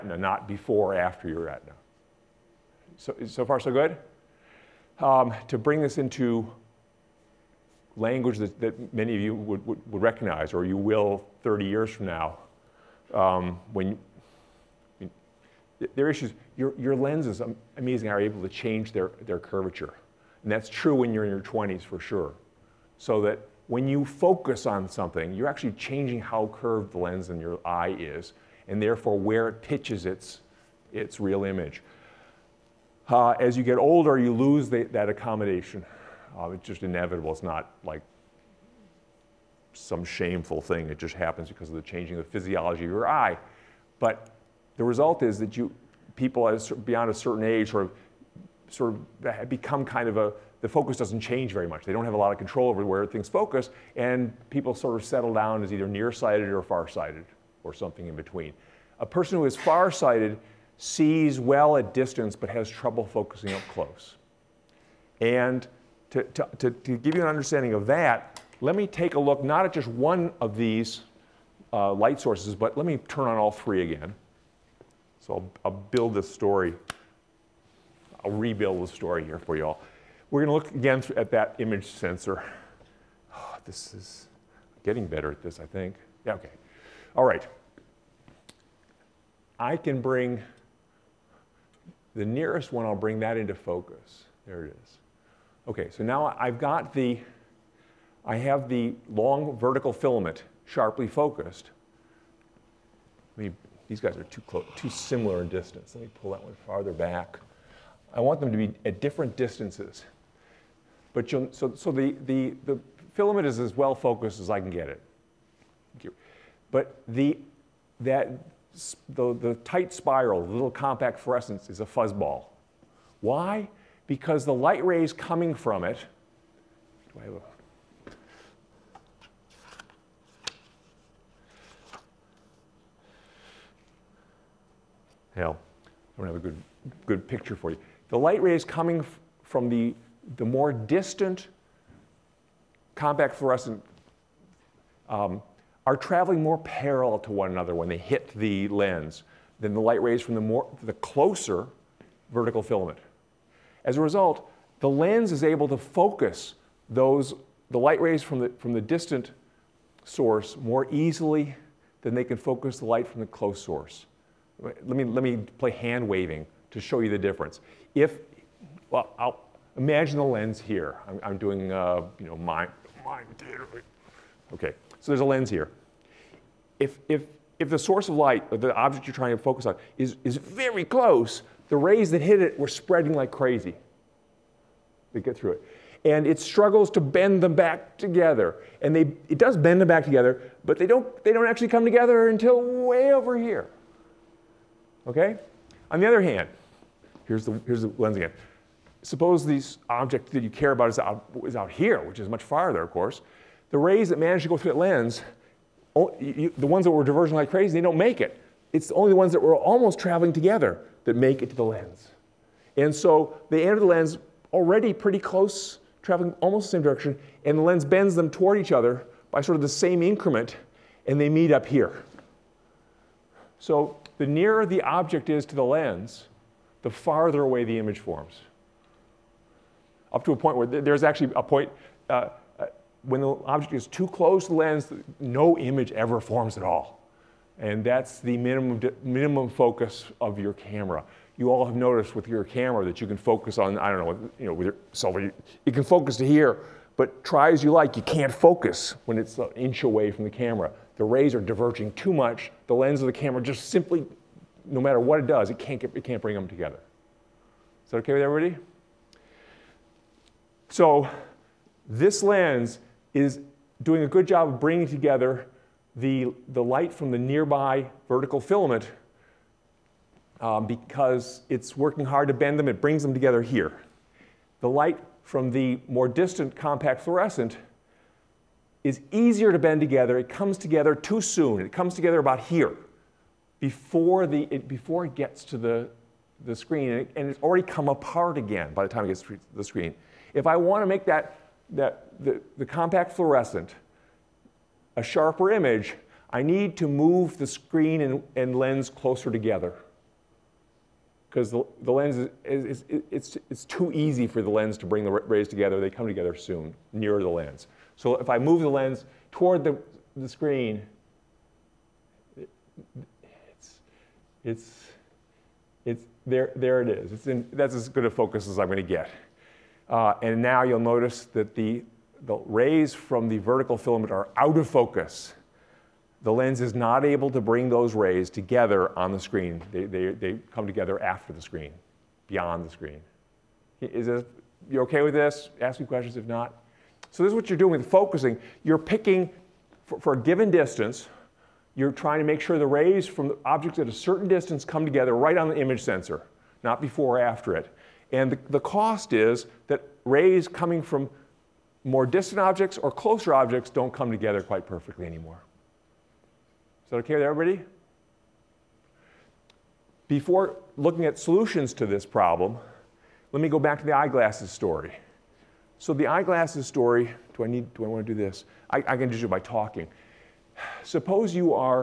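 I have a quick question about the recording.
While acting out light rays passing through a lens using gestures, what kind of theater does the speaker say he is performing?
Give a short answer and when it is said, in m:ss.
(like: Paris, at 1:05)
mime, at 2:53.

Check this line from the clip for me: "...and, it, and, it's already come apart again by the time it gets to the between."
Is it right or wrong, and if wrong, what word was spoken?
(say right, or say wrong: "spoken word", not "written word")
wrong: "screen", not "between".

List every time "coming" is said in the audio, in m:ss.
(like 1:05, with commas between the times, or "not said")
2:05, 2:18, 5:50.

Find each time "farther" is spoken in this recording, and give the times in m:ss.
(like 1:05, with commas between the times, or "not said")
1:46, 3:22, 3:46.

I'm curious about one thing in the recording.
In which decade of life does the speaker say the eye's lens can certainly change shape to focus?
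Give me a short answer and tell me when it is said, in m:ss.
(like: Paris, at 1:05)
20s, at 0:21.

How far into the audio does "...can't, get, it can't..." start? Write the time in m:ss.
4:15.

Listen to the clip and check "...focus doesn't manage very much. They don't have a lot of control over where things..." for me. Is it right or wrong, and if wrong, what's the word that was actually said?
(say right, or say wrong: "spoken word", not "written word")
wrong: "change", not "manage".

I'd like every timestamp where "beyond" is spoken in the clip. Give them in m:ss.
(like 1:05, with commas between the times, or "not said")
0:46, 5:32.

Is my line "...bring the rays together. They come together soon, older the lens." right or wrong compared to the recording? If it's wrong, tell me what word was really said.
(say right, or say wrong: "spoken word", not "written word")
wrong: "nearer", not "older".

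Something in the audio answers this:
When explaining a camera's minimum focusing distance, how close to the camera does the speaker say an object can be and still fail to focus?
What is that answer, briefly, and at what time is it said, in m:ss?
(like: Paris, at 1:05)
an inch, at 4:09.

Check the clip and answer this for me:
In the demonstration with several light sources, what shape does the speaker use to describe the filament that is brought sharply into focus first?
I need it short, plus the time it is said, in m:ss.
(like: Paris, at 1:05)
long vertical, at 1:39.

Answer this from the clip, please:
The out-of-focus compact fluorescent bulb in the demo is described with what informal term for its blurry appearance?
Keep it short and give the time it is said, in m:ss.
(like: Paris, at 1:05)
a fuzzball, at 2:01.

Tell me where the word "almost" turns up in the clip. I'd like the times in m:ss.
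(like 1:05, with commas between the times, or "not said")
3:29, 3:36.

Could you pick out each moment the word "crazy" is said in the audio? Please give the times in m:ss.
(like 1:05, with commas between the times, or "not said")
3:03, 3:27.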